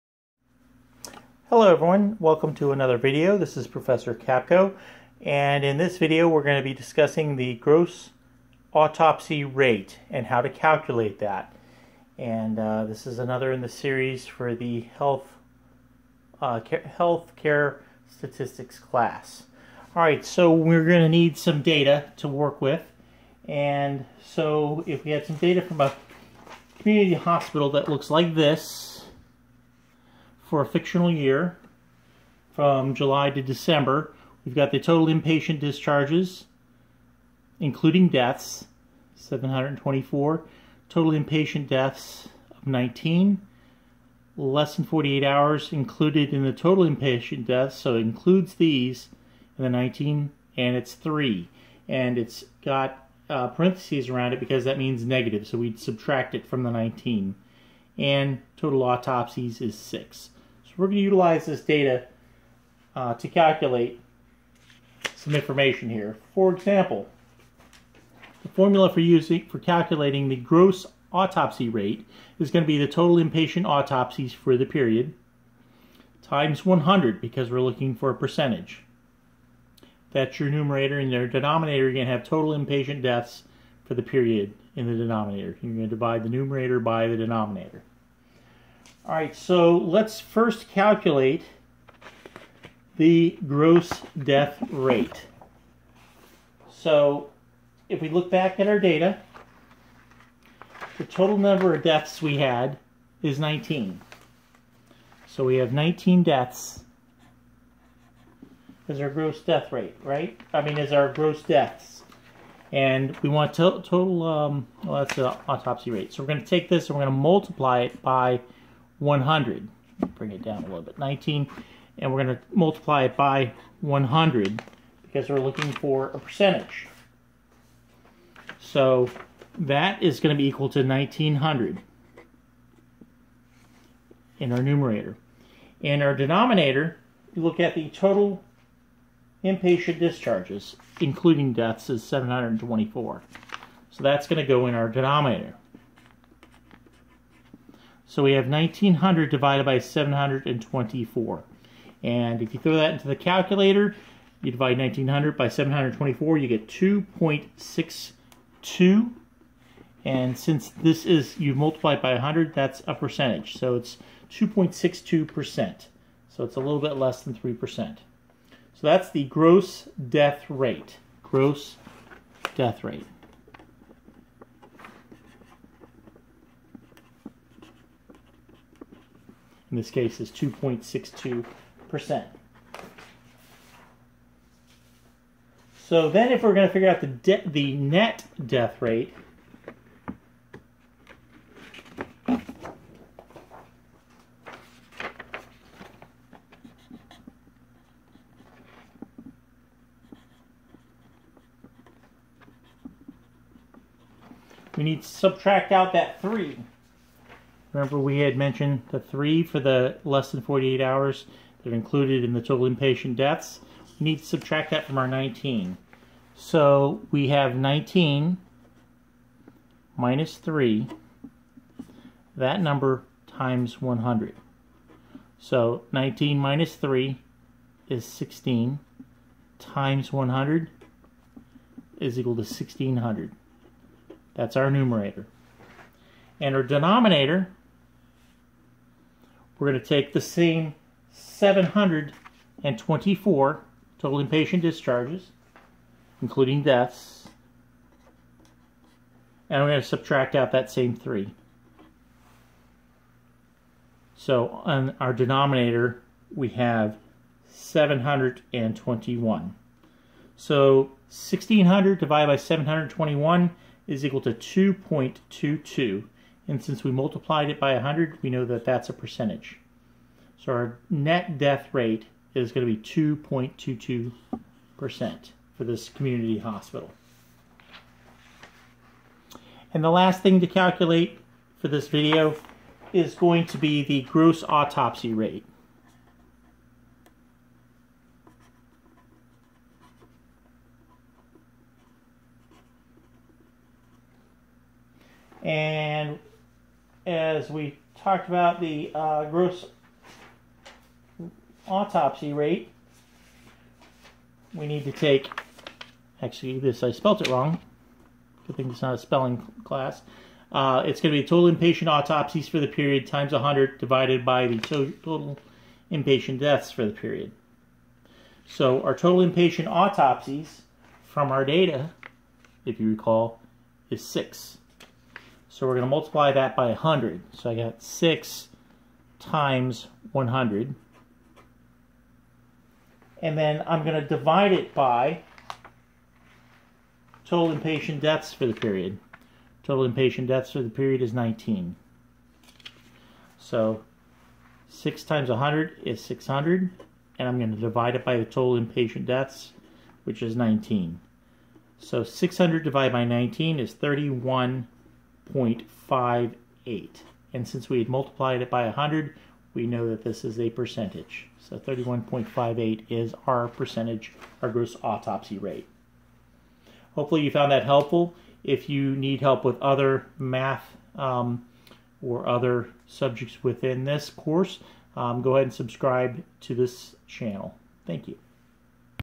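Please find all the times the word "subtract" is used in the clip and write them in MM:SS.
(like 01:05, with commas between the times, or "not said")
00:55, 03:25, 03:34, 04:09.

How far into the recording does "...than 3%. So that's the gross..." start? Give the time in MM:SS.
02:47.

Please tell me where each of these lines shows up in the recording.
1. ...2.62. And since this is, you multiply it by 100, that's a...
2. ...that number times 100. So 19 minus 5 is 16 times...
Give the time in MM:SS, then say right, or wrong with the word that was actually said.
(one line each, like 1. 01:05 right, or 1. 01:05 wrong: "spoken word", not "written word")
1. 02:36 right
2. 03:42 wrong: "3", not "5".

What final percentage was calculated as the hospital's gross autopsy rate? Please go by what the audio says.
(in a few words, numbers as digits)
31.58%.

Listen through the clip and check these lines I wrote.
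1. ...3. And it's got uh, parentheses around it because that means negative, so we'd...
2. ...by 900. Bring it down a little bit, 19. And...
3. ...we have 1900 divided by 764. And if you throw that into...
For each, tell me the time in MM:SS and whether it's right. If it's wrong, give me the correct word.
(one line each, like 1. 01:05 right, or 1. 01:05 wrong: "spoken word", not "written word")
1. 00:50 right
2. 01:58 wrong: "100", not "900"
3. 02:28 wrong: "724", not "764".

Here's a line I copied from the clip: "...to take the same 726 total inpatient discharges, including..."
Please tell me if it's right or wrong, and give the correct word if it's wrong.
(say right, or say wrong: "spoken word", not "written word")
wrong: "724", not "726".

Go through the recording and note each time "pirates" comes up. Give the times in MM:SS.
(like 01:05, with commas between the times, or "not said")
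not said.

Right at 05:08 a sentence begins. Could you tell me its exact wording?
Good thing it's not a spelling class.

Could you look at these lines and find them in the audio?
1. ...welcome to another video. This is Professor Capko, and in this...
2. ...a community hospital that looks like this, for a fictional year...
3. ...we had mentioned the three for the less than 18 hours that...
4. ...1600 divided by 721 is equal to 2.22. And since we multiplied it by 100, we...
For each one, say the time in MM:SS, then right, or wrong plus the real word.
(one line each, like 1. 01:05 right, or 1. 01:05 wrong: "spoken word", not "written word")
1. 00:02 right
2. 00:25 right
3. 03:27 wrong: "48", not "18"
4. 04:21 right.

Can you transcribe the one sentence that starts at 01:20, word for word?
That's your numerator and your denominator.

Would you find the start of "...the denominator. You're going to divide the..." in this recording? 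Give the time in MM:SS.
01:24.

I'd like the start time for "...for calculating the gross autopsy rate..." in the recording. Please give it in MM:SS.
01:09.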